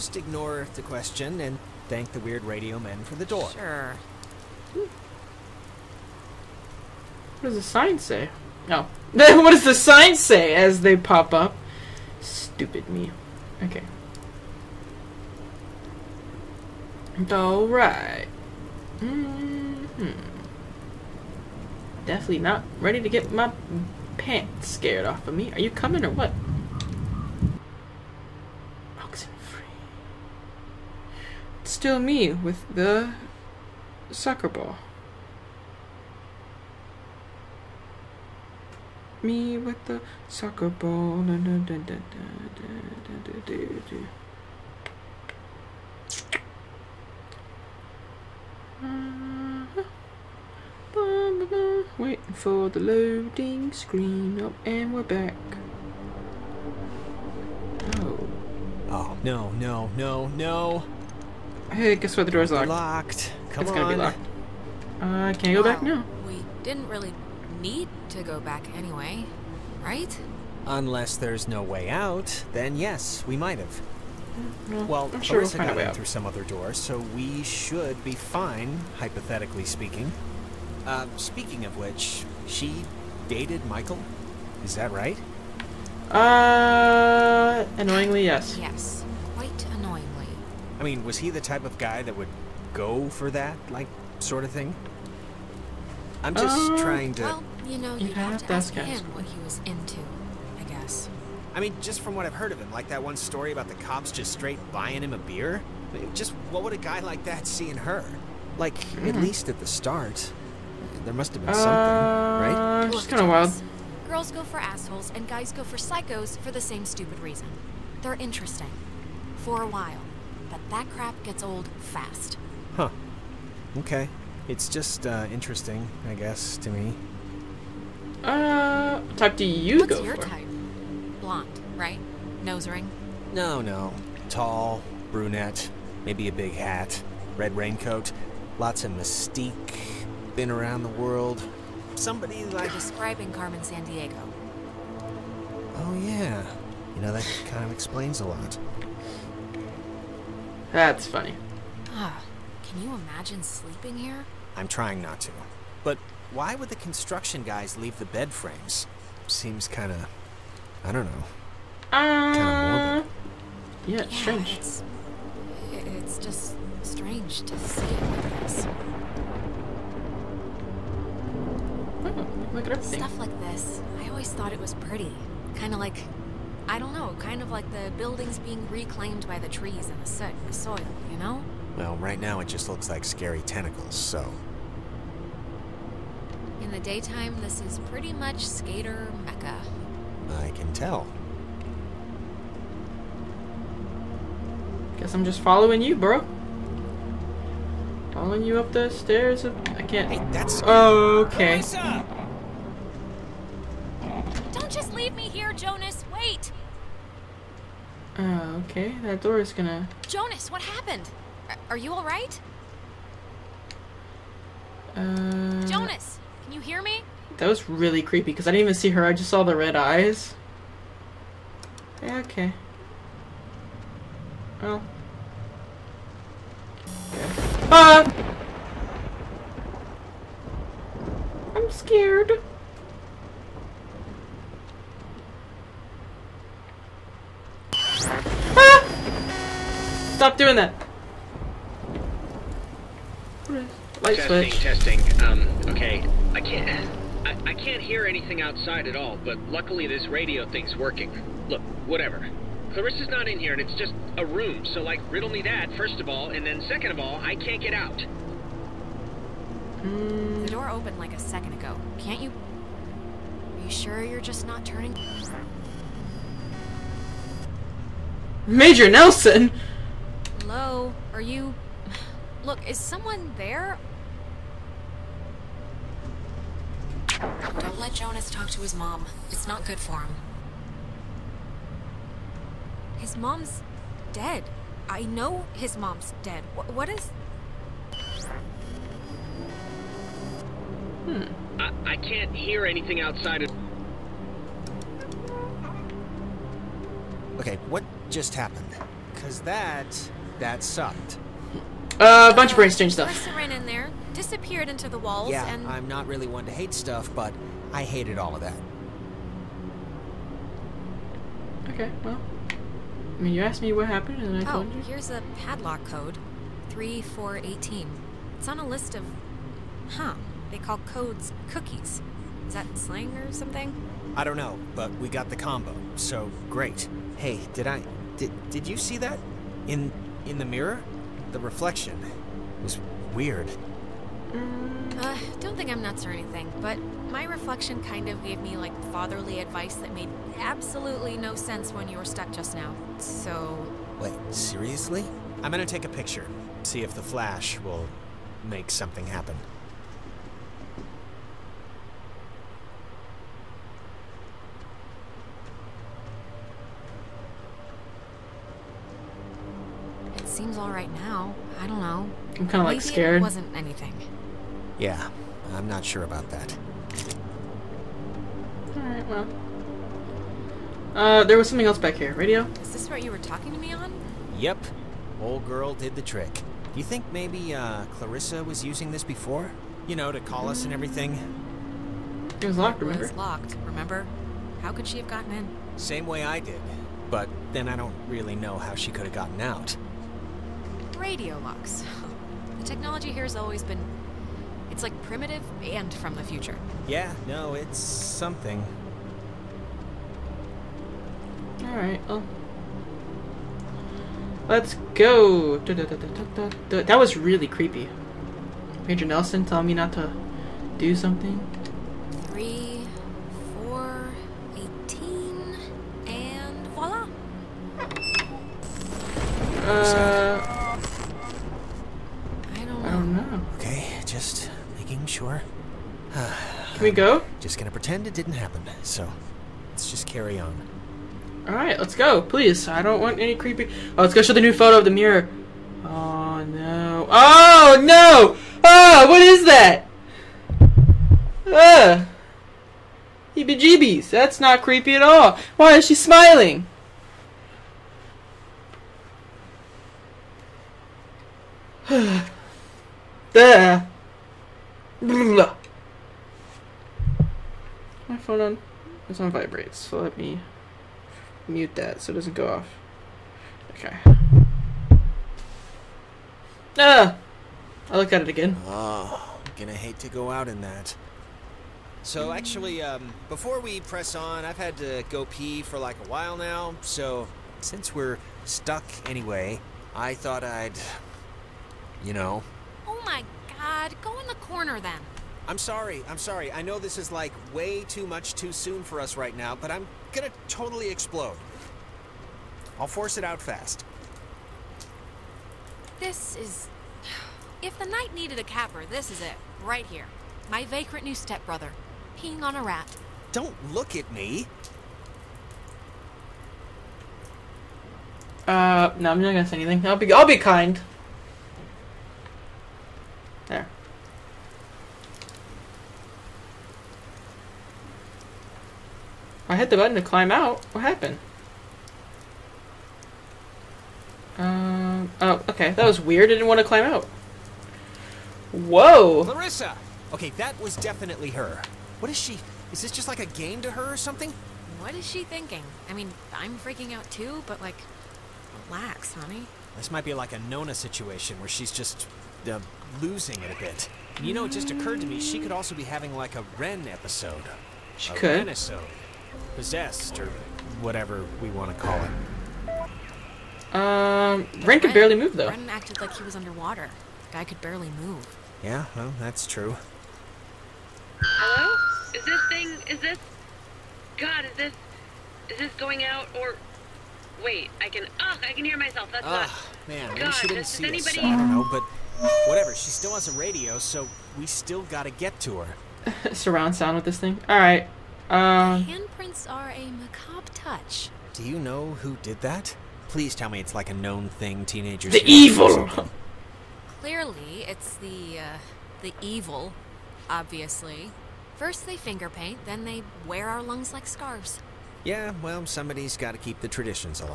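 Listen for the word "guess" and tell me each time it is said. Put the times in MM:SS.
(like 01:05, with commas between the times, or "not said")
01:01, 01:40, 02:06, 03:14.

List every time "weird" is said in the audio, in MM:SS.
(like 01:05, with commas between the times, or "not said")
00:02, 05:33, 08:46.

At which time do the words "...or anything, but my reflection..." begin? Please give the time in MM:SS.
05:36.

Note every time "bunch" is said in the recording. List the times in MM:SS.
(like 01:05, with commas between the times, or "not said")
05:02.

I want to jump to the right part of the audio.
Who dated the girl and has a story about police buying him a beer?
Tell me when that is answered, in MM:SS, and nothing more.
01:23.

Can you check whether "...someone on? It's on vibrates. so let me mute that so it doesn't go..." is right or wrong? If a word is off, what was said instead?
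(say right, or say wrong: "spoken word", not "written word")
wrong: "phone", not "someone".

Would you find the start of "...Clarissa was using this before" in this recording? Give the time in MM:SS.
06:17.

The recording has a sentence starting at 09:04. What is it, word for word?
You know, it just occurred to me she could also be having like a Ren episode.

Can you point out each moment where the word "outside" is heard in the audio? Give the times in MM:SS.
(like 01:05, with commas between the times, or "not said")
04:08, 04:53.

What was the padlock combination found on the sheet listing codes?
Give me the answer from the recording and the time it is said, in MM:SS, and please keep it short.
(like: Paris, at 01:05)
3418, at 05:16.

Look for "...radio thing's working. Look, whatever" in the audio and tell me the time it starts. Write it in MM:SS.
04:10.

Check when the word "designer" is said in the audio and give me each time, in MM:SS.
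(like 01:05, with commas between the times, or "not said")
not said.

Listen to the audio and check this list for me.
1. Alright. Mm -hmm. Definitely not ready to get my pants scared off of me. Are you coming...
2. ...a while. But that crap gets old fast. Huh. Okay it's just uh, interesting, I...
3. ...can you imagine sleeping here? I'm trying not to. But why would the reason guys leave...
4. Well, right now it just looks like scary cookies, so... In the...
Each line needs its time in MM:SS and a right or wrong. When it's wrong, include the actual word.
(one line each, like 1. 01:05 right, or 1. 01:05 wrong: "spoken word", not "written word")
1. 00:17 right
2. 01:59 right
3. 02:32 wrong: "construction", not "reason"
4. 03:01 wrong: "tentacles", not "cookies".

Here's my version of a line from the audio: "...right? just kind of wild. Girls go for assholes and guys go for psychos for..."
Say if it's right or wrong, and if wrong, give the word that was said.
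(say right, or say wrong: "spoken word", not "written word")
right.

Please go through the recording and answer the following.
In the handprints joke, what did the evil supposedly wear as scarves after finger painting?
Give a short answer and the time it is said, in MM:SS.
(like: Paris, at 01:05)
our lungs, at 09:53.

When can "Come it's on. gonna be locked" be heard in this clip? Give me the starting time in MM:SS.
01:03.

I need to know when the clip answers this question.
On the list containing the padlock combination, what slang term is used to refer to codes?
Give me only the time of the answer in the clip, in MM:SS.
05:21.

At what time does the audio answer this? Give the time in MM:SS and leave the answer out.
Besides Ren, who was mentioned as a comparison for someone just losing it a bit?
09:00.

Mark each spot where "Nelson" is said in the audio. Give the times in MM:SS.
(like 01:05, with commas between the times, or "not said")
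04:28, 06:49.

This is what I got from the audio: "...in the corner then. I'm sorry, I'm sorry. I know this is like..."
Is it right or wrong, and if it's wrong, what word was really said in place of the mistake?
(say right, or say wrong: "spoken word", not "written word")
right.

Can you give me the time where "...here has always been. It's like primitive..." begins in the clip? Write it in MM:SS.
06:33.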